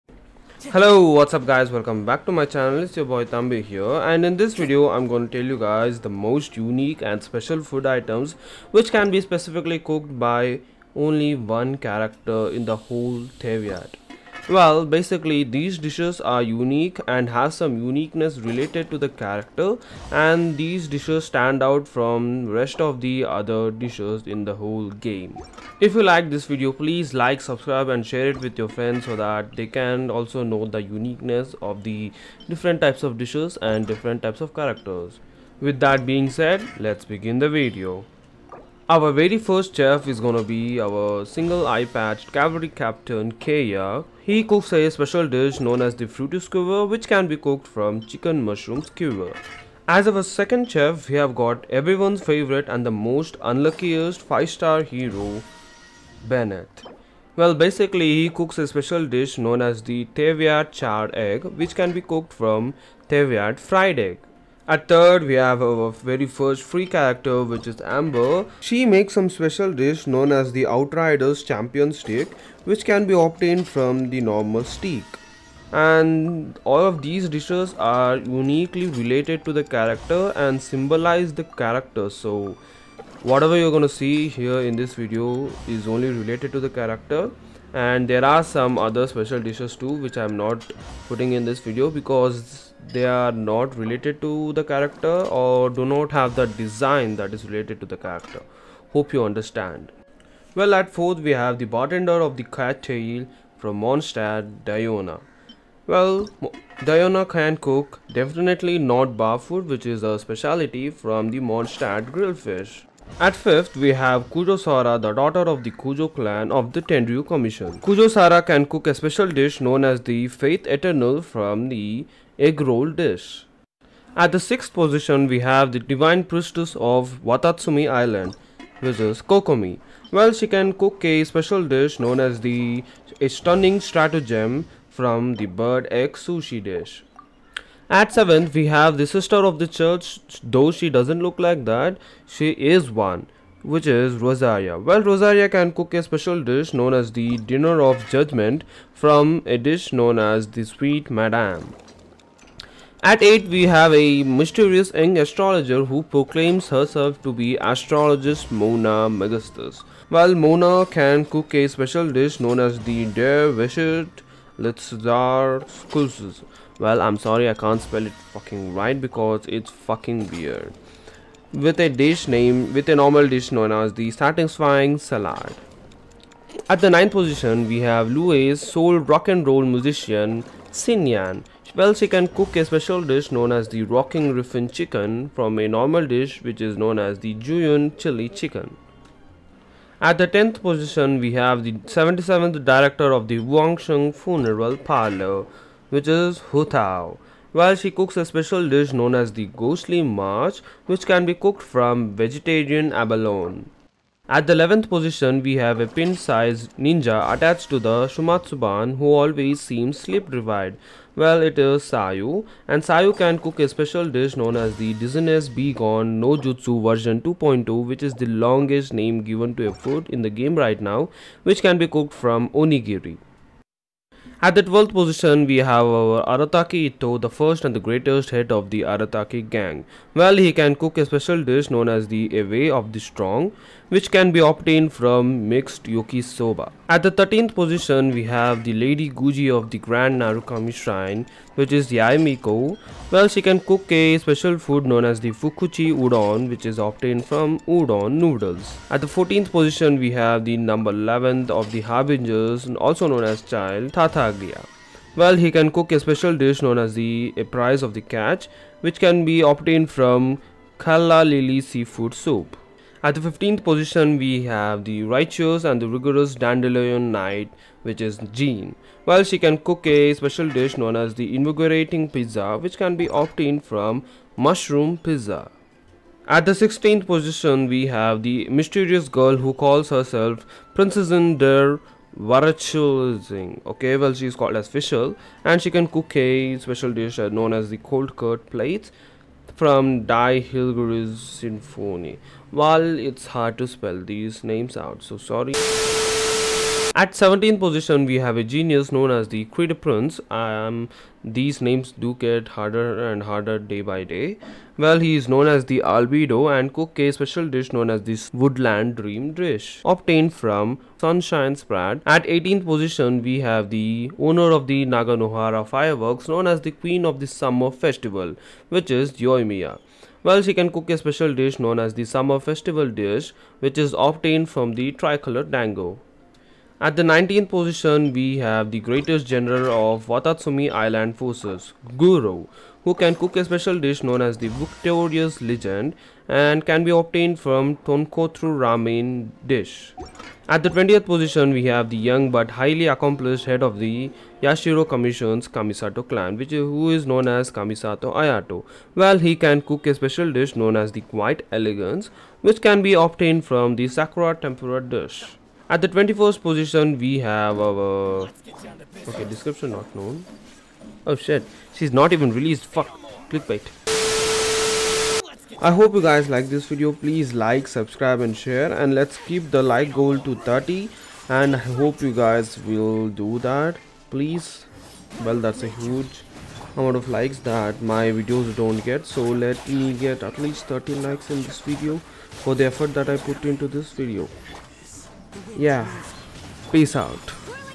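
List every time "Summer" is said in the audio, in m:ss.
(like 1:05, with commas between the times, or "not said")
5:17, 5:22.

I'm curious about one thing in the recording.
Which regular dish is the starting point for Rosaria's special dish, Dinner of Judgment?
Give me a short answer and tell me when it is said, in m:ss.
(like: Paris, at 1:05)
Sweet Madame, at 2:30.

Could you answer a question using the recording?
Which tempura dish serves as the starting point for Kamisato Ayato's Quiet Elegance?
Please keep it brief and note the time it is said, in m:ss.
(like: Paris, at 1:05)
Sakura Tempura, at 5:53.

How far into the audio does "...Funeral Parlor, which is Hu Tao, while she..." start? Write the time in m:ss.
3:14.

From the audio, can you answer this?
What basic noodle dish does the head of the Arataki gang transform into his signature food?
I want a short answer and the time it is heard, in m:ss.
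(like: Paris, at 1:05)
Mixed yakisoba, at 3:55.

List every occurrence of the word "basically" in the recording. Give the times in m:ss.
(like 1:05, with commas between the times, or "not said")
0:14, 0:57.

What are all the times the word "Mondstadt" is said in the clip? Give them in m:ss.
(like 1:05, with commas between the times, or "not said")
1:43, 1:51.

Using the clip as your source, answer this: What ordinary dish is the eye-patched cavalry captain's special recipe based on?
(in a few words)
Chicken mushroom skewer.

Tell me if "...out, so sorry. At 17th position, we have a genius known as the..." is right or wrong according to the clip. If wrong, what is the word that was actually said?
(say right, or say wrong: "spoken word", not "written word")
right.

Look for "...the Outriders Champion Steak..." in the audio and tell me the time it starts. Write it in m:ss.
1:10.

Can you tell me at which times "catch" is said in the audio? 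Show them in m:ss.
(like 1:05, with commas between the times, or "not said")
4:18.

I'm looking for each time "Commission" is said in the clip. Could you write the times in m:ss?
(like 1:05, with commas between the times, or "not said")
1:57, 5:44.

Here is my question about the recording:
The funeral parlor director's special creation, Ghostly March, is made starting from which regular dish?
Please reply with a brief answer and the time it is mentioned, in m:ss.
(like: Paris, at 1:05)
Vegetarian abalone, at 3:22.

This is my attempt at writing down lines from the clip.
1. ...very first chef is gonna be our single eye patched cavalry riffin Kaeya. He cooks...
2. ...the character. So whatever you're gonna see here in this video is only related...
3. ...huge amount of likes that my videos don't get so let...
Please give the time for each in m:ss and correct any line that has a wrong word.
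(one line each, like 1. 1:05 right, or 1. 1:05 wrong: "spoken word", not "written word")
1. 0:39 wrong: "captain", not "riffin"
2. 1:21 right
3. 6:15 right.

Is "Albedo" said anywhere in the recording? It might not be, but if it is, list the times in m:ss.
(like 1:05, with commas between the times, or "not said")
5:05.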